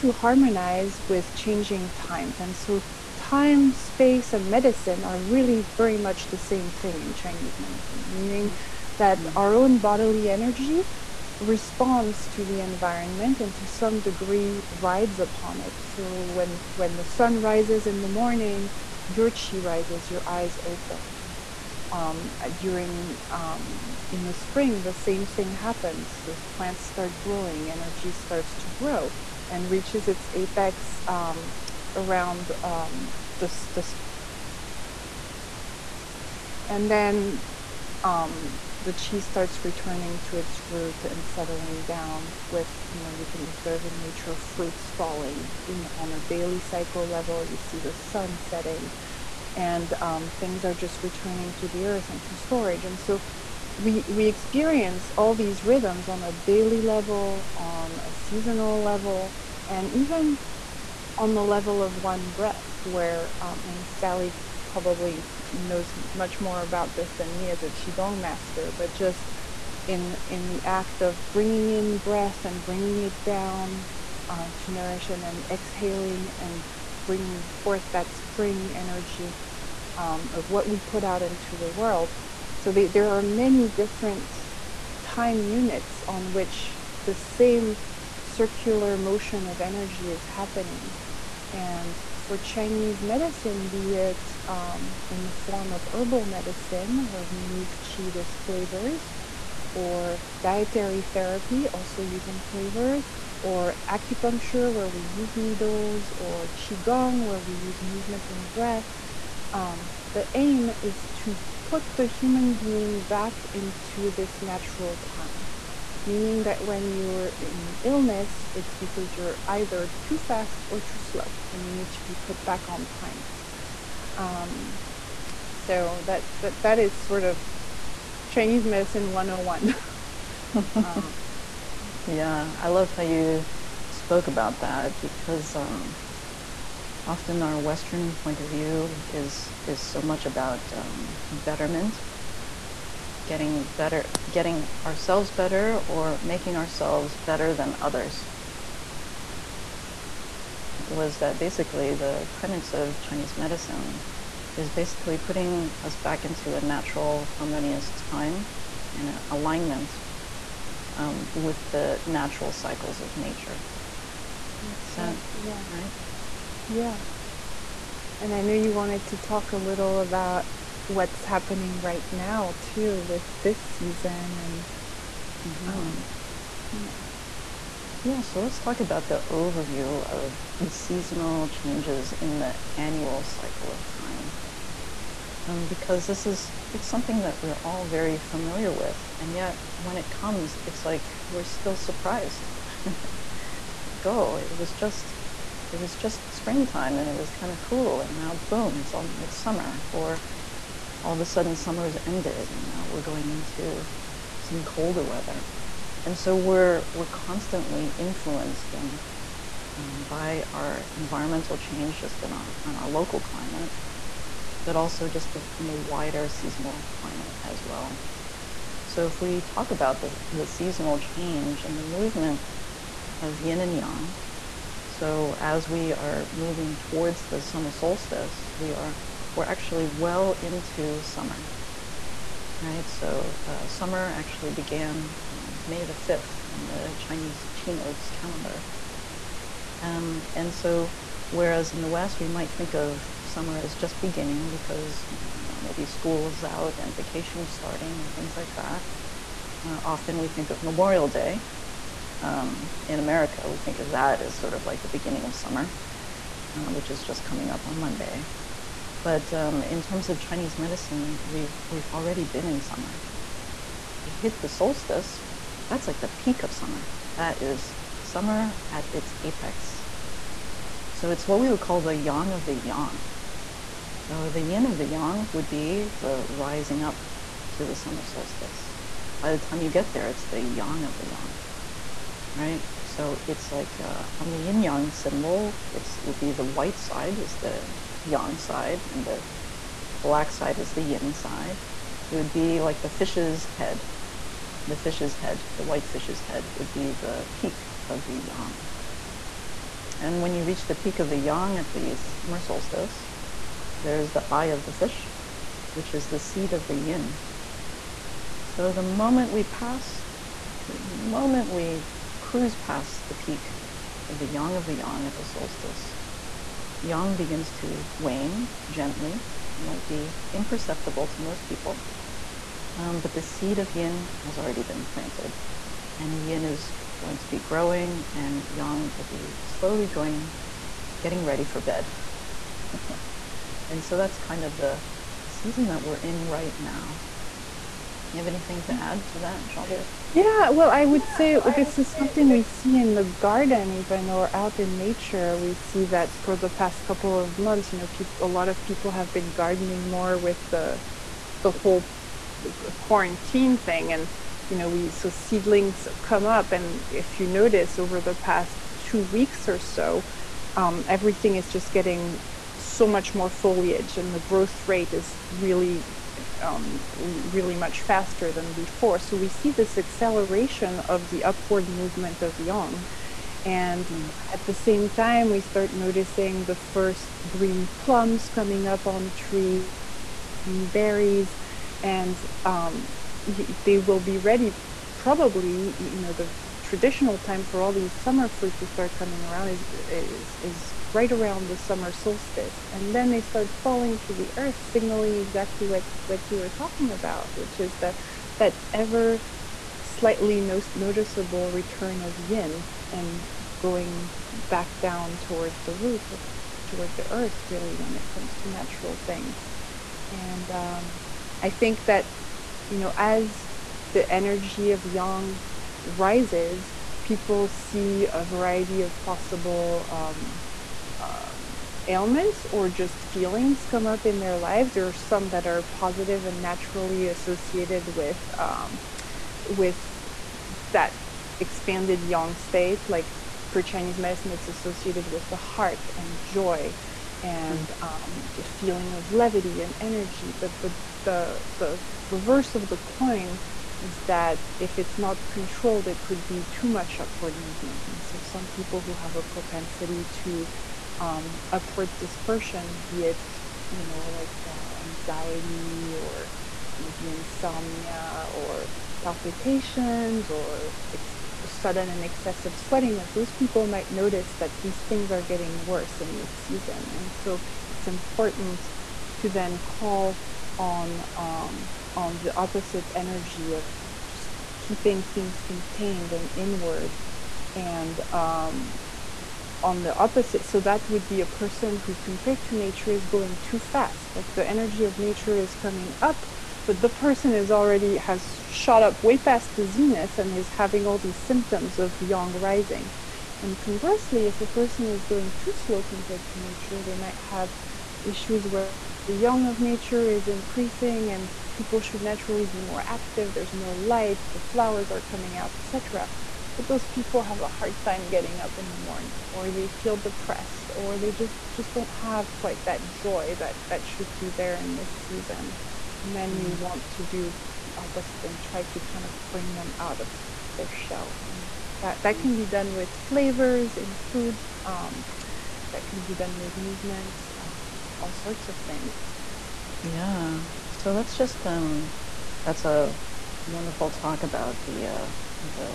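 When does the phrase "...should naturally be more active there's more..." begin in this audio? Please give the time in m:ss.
8:21.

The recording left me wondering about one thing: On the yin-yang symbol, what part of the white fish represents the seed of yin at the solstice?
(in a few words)
the eye.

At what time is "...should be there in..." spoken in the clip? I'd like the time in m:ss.
8:33.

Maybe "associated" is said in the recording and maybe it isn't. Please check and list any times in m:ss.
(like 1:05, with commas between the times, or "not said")
7:07, 7:14.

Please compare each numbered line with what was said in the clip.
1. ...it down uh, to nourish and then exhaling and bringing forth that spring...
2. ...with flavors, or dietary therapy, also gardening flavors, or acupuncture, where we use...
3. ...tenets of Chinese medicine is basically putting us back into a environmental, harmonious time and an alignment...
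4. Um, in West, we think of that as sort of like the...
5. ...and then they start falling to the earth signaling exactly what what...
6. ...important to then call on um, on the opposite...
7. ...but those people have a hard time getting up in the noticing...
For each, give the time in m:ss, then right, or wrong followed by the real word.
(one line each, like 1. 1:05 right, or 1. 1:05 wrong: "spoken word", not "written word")
1. 1:13 right
2. 1:38 wrong: "using", not "gardening"
3. 2:32 wrong: "natural", not "environmental"
4. 4:12 wrong: "America", not "West"
5. 6:32 right
6. 7:47 right
7. 8:26 wrong: "morning", not "noticing".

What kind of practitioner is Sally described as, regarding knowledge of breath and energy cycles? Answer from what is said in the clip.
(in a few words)
qigong master.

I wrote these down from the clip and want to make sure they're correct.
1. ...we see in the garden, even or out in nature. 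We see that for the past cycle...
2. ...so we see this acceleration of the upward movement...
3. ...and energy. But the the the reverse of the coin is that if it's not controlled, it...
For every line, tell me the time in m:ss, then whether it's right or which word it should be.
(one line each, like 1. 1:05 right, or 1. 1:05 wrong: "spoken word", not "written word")
1. 5:42 wrong: "couple", not "cycle"
2. 6:08 right
3. 7:19 right.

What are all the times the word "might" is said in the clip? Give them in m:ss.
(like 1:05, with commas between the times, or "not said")
4:02, 5:19, 7:43, 8:16.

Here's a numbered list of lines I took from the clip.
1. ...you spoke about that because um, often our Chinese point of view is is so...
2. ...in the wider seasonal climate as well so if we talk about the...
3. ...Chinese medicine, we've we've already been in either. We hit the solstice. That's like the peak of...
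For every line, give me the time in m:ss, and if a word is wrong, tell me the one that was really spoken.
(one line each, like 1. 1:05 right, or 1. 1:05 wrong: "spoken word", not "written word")
1. 2:13 wrong: "Western", not "Chinese"
2. 3:35 right
3. 4:20 wrong: "summer", not "either".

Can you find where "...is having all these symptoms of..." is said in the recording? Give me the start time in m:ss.
8:10.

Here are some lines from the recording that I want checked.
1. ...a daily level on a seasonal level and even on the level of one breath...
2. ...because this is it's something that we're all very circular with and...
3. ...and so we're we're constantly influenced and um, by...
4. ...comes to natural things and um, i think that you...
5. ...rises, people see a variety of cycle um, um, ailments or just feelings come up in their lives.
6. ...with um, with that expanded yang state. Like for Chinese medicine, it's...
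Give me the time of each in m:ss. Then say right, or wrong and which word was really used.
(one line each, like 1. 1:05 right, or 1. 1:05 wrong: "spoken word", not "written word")
1. 0:56 right
2. 3:05 wrong: "familiar", not "circular"
3. 3:26 right
4. 6:48 right
5. 6:55 wrong: "possible", not "cycle"
6. 7:07 right.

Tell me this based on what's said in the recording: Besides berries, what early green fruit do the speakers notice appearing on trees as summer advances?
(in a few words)
plums.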